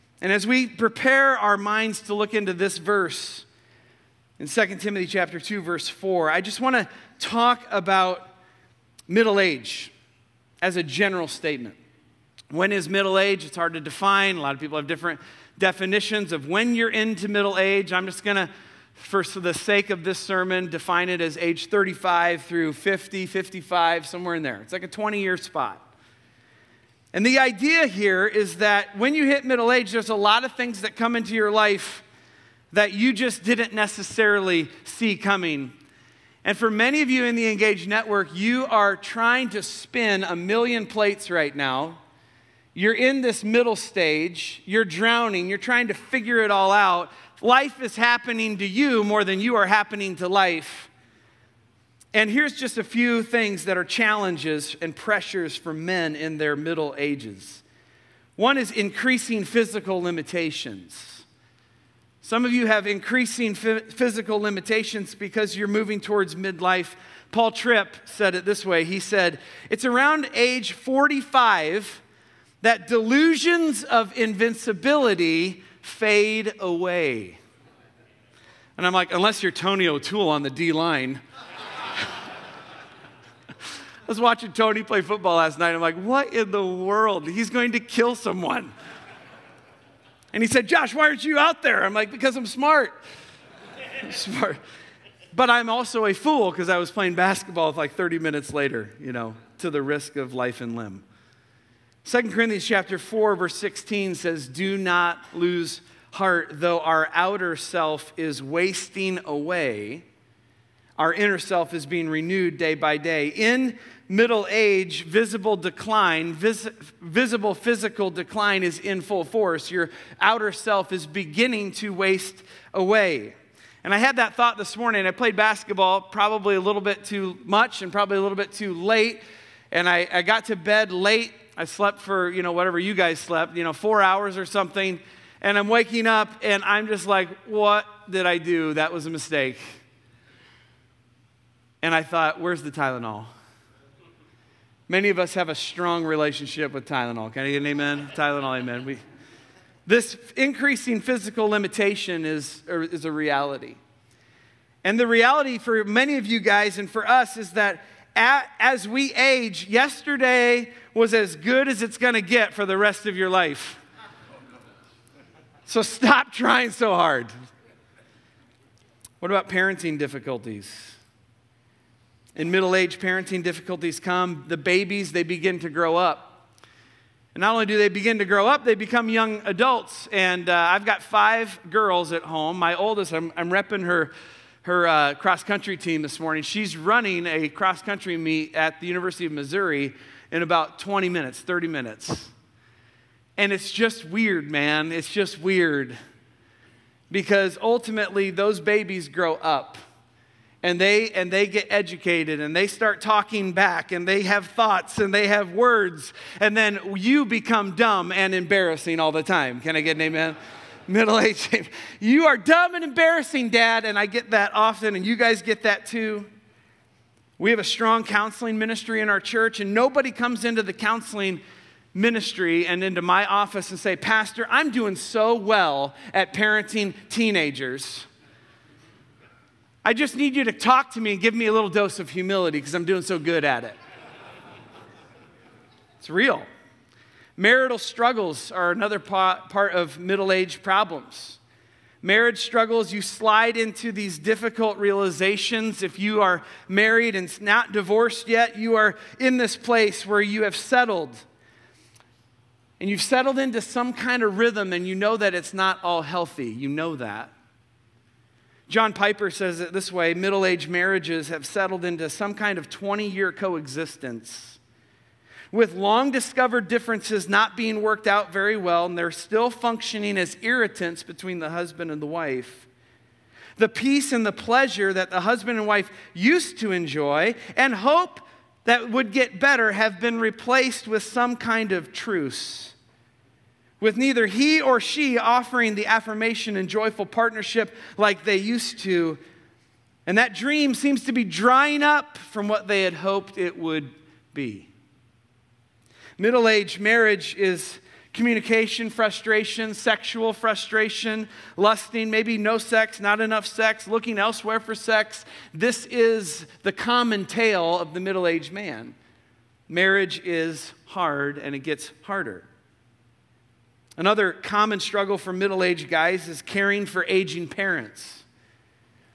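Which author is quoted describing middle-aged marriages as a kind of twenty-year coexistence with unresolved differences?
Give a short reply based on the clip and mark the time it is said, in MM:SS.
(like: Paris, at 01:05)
John Piper, at 04:18.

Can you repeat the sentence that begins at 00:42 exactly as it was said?
You're in this middle stage, you're drowning, you're trying to figure it all out.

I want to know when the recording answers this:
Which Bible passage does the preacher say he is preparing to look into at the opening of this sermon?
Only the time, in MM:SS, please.
00:04.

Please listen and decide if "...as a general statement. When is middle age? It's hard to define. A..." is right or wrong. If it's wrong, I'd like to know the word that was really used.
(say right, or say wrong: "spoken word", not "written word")
right.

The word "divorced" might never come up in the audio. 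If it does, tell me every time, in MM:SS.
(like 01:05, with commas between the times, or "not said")
04:07.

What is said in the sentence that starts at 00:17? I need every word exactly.
I'm just going to for the sake of this sermon, define it as age 35 through 50, 55, somewhere in there.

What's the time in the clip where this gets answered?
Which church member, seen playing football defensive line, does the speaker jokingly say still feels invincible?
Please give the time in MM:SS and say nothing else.
01:19.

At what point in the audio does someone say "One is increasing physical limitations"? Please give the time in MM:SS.
00:58.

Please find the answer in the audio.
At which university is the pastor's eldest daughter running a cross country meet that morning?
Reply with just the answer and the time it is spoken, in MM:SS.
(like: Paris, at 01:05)
University of Missouri, at 03:08.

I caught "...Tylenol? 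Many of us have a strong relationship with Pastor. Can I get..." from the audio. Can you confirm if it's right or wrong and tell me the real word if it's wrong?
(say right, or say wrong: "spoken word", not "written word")
wrong: "Tylenol", not "Pastor".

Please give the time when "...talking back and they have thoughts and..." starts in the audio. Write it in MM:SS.
03:23.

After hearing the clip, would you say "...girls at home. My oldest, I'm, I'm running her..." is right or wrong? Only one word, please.
wrong.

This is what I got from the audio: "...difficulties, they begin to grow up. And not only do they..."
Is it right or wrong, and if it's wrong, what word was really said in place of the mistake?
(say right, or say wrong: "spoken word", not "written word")
wrong: "babies", not "difficulties".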